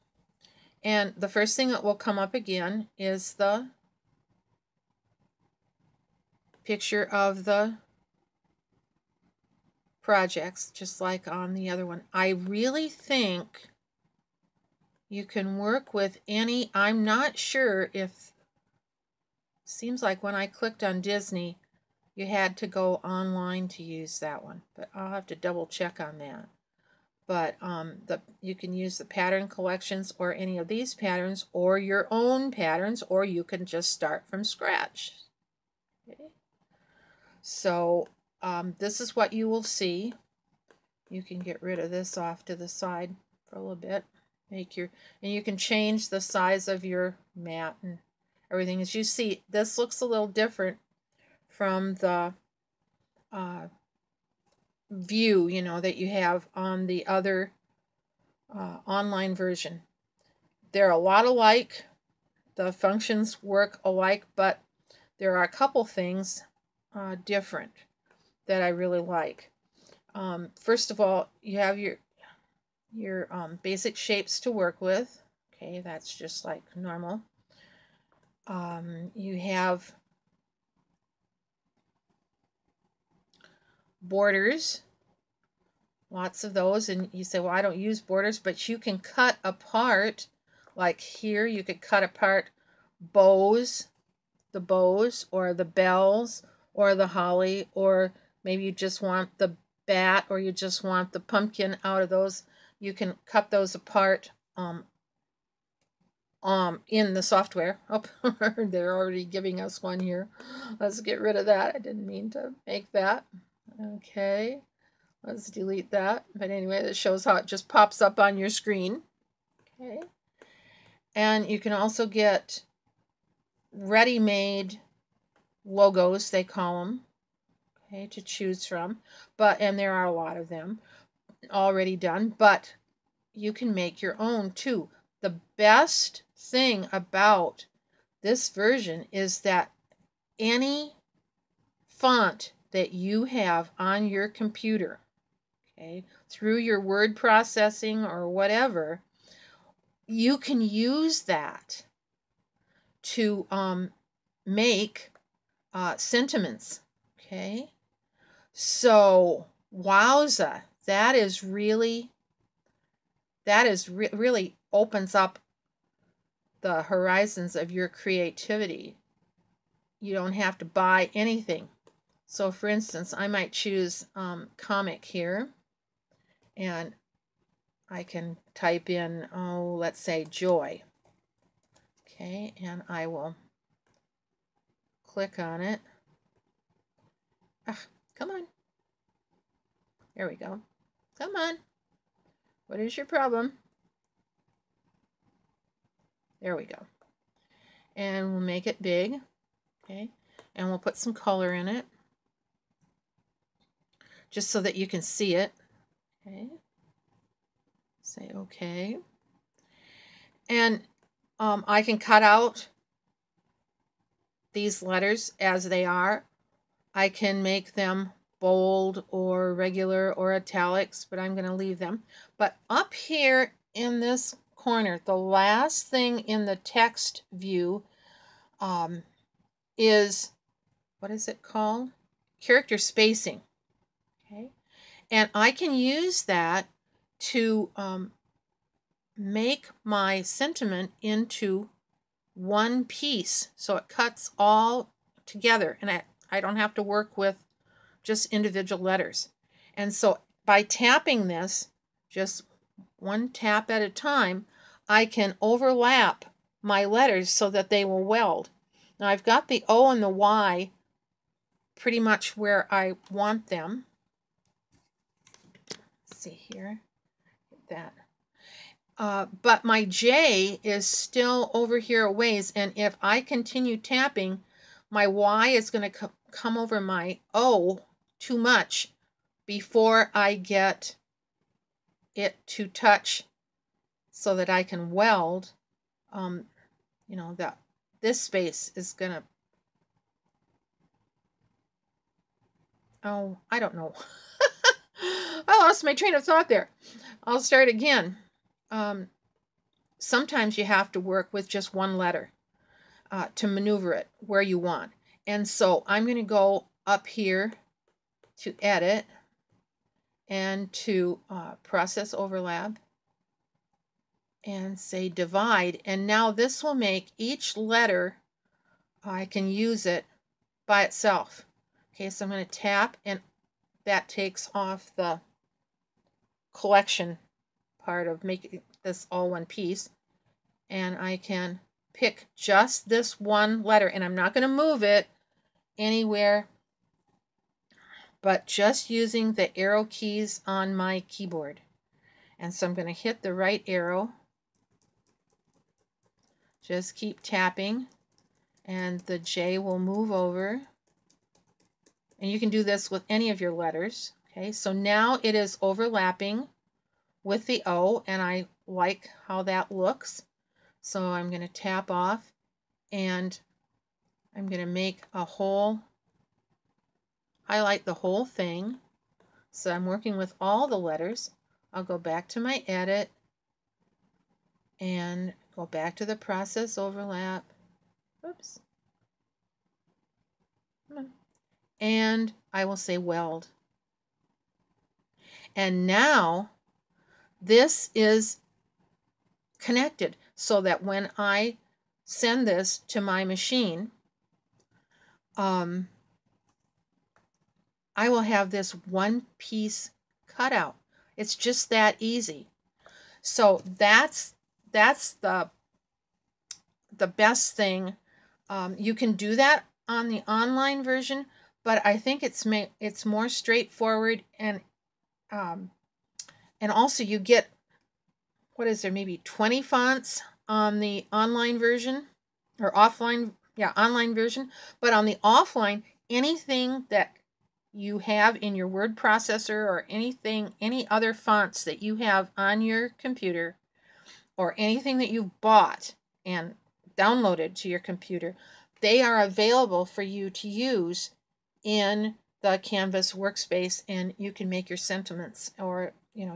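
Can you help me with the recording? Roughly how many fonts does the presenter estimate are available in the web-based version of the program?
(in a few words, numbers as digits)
20.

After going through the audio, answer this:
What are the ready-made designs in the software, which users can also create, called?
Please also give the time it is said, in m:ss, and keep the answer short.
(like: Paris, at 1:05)
logos, at 2:05.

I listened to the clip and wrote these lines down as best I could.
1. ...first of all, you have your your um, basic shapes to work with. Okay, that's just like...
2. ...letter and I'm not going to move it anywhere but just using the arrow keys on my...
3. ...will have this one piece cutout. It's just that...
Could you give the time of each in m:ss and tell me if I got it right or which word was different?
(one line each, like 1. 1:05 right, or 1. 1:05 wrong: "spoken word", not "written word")
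1. 1:10 right
2. 5:33 right
3. 6:38 right.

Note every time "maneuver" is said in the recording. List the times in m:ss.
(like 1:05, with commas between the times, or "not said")
5:03.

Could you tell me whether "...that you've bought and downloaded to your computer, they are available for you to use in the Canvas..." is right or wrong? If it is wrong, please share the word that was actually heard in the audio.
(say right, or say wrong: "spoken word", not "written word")
right.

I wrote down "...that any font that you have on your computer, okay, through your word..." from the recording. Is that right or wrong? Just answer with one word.
right.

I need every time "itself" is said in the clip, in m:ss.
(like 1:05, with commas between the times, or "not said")
5:20.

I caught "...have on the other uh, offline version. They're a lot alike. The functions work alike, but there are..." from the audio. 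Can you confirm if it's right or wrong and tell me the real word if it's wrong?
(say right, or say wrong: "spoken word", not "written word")
wrong: "online", not "offline".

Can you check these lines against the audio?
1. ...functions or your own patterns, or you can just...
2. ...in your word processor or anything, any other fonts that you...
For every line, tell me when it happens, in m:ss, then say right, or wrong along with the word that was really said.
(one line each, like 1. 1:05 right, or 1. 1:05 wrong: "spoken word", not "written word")
1. 0:30 wrong: "patterns", not "functions"
2. 7:08 right.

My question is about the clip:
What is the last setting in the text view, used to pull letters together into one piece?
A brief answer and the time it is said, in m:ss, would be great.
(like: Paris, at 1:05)
Character spacing, at 3:52.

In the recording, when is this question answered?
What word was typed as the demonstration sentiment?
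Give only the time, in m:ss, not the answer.
3:00.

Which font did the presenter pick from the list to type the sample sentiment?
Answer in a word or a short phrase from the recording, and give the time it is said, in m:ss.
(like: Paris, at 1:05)
comic, at 2:54.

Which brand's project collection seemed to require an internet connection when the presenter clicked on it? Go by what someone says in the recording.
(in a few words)
Disney.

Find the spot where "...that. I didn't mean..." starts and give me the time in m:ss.
1:51.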